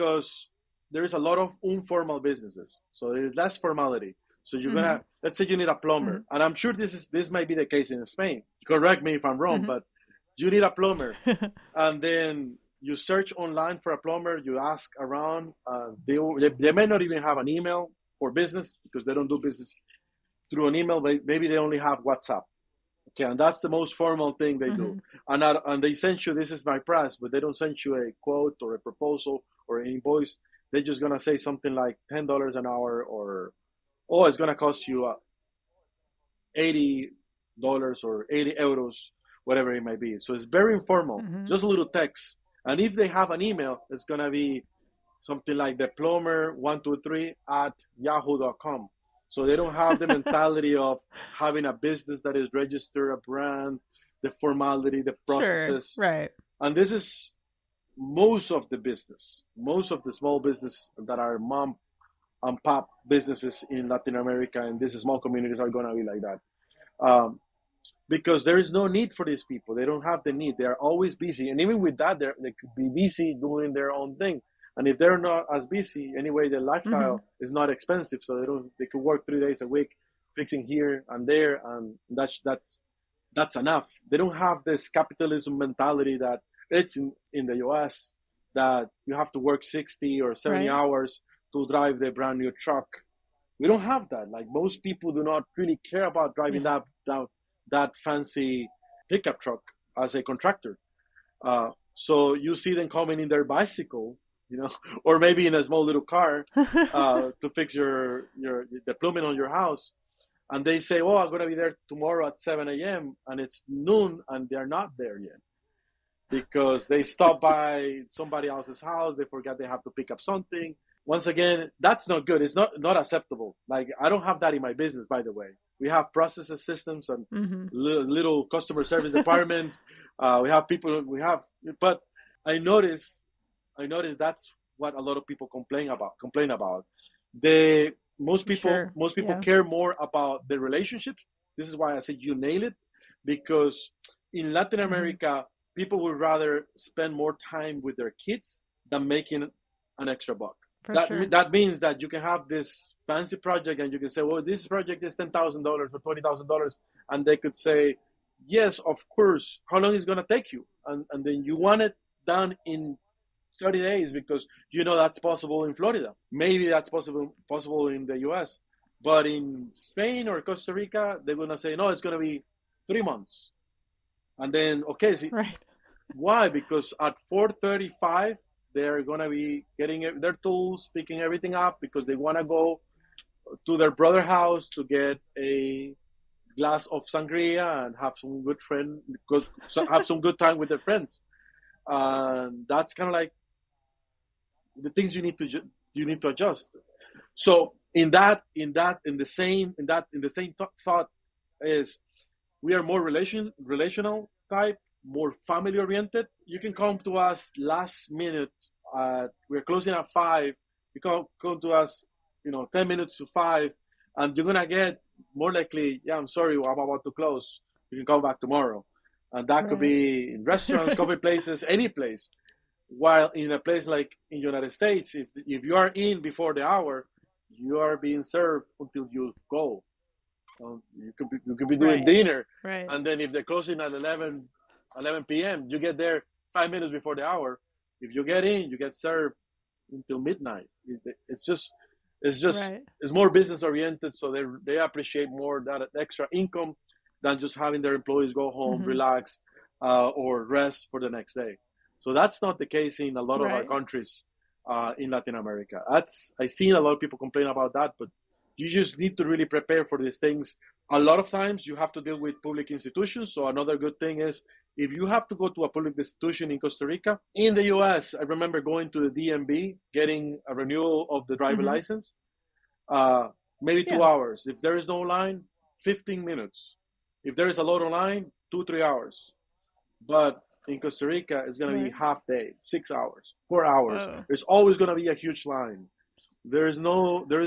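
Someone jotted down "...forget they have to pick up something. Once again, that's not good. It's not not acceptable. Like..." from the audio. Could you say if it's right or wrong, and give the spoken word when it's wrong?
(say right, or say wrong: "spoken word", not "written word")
right.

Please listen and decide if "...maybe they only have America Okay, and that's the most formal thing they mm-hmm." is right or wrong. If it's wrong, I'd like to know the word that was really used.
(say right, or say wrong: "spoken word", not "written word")
wrong: "WhatsApp", not "America".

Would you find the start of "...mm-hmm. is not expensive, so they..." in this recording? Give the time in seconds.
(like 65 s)
77 s.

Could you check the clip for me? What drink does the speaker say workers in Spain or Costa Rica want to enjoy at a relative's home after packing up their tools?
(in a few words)
sangria.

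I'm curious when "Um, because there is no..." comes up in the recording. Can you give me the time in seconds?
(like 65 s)
67 s.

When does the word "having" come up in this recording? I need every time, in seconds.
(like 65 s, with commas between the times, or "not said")
51 s, 247 s.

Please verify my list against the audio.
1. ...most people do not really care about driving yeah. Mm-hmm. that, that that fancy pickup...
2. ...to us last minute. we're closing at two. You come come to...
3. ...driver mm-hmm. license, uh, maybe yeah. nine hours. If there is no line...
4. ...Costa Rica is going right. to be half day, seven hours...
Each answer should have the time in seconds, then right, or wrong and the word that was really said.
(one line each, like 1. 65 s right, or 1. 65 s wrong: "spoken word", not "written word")
1. 94 s right
2. 206 s wrong: "five", not "two"
3. 271 s wrong: "two", not "nine"
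4. 280 s wrong: "six", not "seven".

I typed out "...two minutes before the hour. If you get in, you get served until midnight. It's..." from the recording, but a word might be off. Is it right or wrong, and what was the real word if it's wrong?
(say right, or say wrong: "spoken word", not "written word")
wrong: "five", not "two".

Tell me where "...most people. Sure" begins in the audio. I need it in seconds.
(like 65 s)
138 s.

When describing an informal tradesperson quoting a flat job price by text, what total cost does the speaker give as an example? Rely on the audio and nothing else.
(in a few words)
80 dollars.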